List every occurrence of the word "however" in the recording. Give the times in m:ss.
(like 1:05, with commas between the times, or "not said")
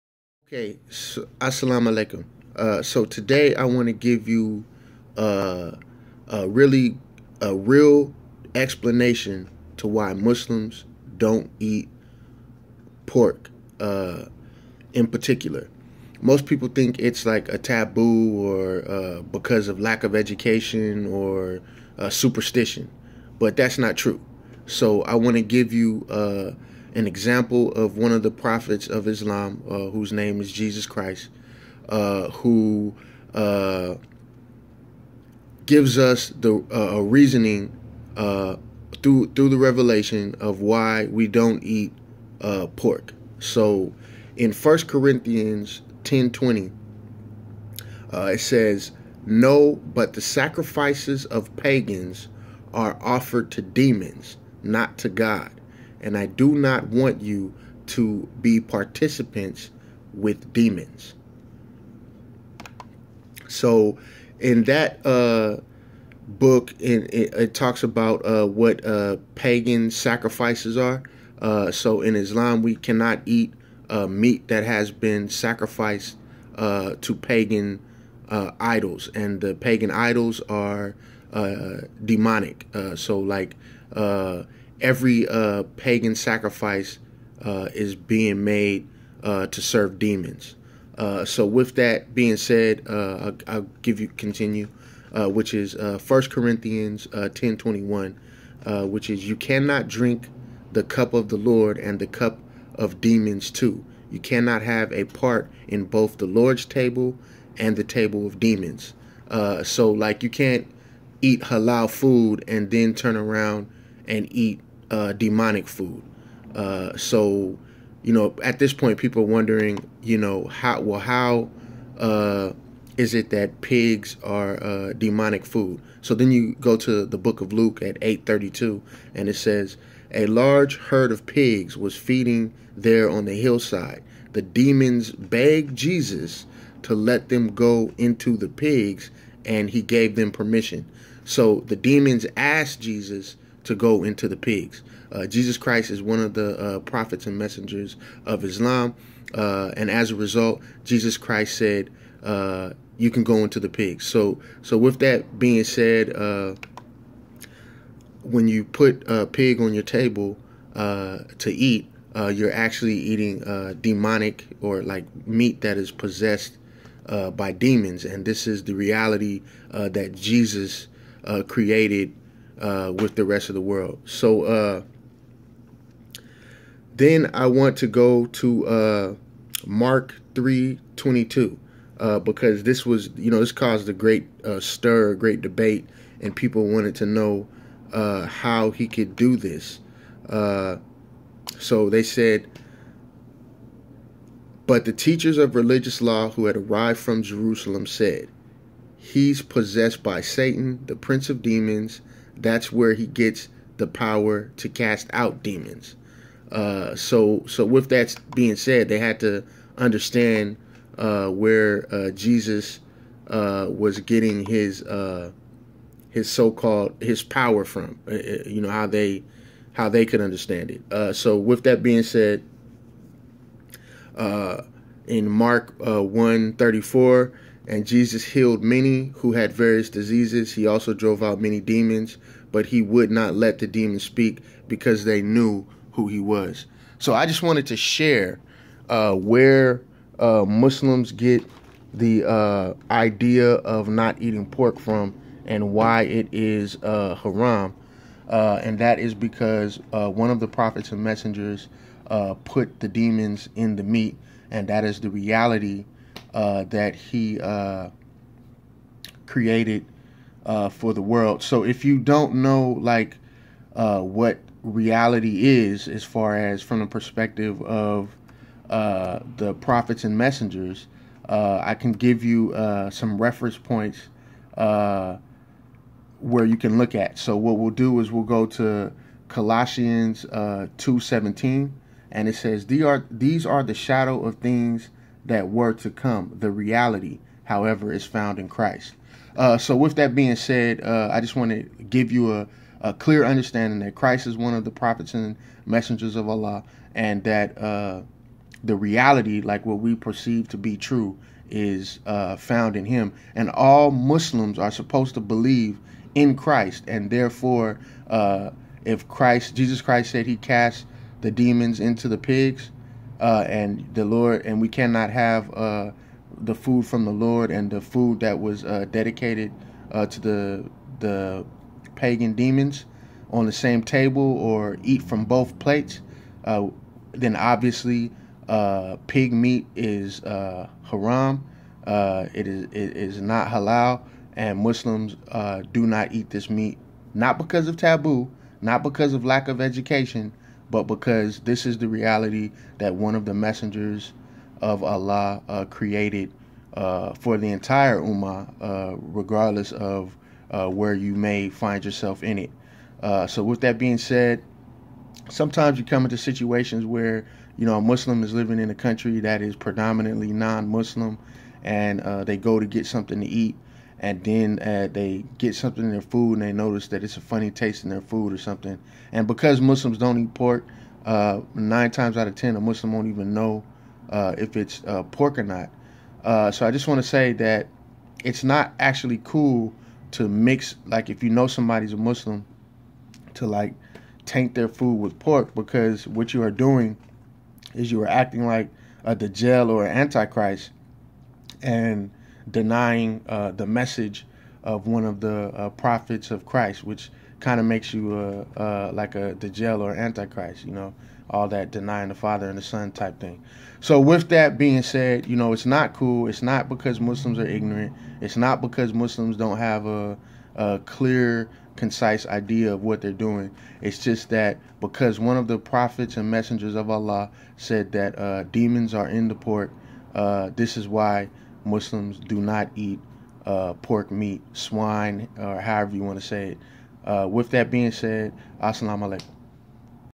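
4:47, 7:05.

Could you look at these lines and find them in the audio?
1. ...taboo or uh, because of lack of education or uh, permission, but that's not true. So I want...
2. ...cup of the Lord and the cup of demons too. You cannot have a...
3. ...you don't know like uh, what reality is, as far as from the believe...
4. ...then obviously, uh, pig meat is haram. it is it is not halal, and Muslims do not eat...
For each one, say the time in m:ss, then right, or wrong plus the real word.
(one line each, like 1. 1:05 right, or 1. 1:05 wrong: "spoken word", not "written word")
1. 0:17 wrong: "superstition", not "permission"
2. 1:40 right
3. 4:21 wrong: "perspective", not "believe"
4. 5:27 right.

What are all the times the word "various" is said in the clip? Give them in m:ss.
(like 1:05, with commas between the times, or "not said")
3:49.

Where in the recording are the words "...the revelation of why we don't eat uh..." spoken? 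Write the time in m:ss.
0:39.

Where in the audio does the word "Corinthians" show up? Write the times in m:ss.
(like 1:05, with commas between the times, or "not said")
0:44, 1:36.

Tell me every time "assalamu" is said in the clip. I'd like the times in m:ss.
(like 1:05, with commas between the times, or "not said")
0:01, 7:08.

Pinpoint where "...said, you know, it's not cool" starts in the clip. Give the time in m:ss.
6:44.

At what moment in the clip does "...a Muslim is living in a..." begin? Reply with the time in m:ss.
5:57.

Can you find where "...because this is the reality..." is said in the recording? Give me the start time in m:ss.
5:40.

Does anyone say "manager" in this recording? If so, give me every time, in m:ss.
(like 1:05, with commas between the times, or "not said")
not said.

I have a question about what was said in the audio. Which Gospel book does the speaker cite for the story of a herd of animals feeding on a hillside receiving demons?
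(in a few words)
Luke.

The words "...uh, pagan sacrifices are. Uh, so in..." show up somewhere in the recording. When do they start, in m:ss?
1:08.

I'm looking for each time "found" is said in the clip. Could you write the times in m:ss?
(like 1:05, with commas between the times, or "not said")
4:48, 5:02.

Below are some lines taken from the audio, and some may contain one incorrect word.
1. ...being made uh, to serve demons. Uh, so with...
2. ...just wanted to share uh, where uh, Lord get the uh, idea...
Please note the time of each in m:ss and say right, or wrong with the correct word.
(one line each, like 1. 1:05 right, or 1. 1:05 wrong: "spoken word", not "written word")
1. 1:27 right
2. 3:57 wrong: "Muslims", not "Lord".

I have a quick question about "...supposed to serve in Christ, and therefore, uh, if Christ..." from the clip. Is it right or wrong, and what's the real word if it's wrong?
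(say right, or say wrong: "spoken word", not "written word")
wrong: "believe", not "serve".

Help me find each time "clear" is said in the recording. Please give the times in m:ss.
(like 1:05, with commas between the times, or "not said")
4:52, 6:50.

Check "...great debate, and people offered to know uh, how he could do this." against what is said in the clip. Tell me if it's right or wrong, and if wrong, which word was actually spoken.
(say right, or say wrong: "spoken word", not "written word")
wrong: "wanted", not "offered".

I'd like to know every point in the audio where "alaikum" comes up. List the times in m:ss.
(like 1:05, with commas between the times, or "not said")
0:01, 7:09.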